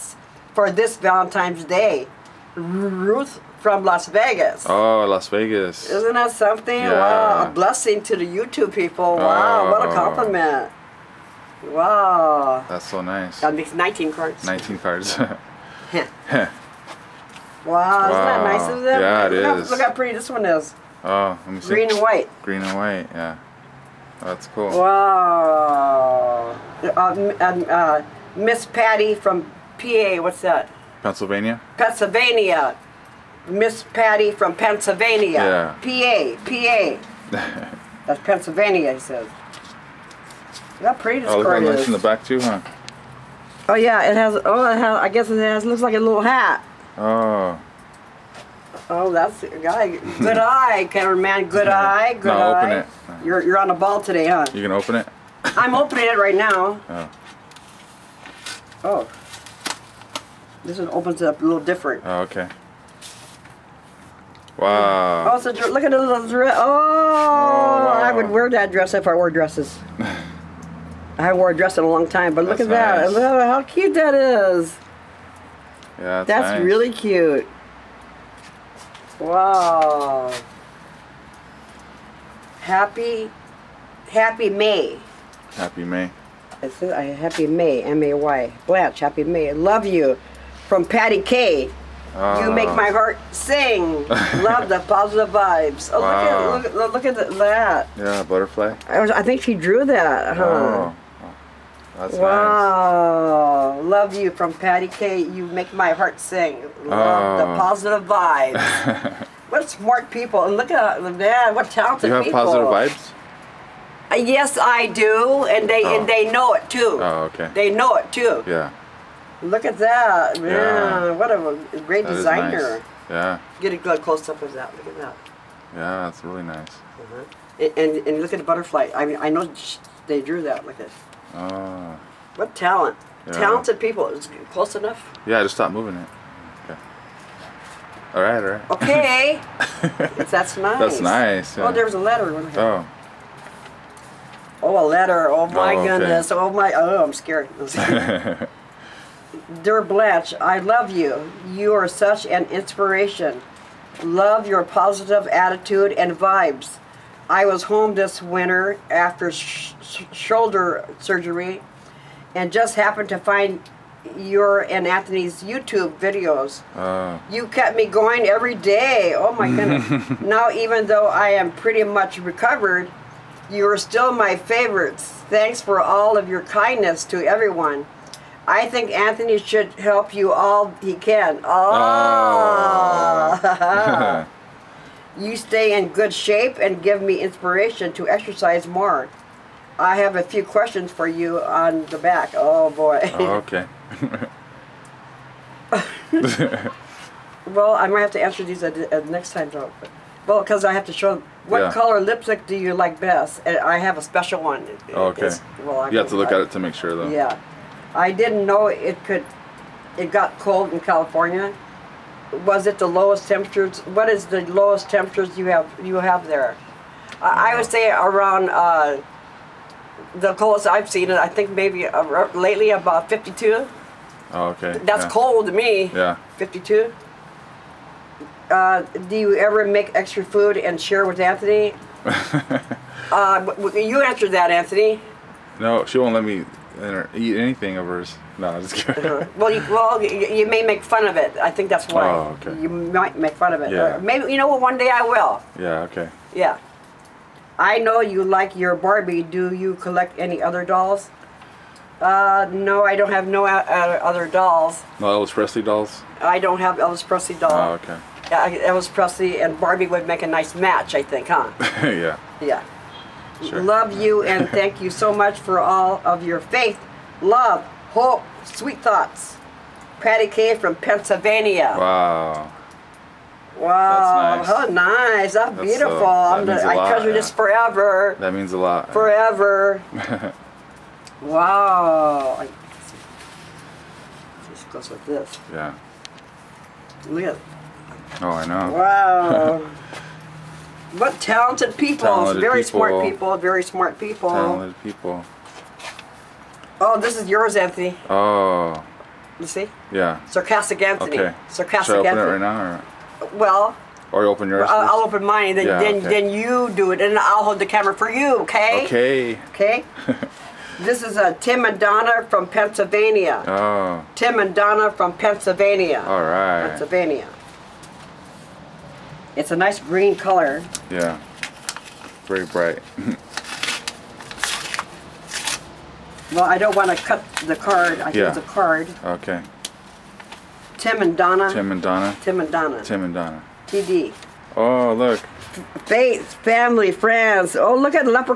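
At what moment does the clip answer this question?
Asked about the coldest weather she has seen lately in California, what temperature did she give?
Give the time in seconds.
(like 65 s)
222 s.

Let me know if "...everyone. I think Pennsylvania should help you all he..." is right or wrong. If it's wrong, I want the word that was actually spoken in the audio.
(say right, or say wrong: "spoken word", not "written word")
wrong: "Anthony", not "Pennsylvania".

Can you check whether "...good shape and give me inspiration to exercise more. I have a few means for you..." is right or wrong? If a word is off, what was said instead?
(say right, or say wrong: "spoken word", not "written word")
wrong: "questions", not "means".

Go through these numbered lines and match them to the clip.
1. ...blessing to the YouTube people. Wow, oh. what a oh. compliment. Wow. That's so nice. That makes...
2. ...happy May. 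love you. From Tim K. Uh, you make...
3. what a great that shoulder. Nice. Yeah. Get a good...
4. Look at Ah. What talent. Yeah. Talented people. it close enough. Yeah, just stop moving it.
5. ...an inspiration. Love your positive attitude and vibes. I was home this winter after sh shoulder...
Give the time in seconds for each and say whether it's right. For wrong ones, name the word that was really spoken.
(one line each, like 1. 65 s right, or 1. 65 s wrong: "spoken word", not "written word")
1. 7 s right
2. 88 s wrong: "Patty", not "Tim"
3. 121 s wrong: "designer", not "shoulder"
4. 130 s right
5. 152 s right.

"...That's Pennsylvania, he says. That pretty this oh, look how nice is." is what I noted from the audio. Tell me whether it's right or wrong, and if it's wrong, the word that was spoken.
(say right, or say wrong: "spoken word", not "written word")
right.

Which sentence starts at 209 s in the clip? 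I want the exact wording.
It got cold in California, was it the lowest temperatures?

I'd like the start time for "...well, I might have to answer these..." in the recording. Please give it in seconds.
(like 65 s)
197 s.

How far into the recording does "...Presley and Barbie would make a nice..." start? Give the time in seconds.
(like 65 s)
258 s.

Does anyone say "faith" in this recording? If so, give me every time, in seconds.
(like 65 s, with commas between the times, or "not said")
266 s, 335 s.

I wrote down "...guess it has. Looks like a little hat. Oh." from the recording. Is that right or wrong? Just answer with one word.
right.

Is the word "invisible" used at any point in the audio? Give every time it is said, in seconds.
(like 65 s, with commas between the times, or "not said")
not said.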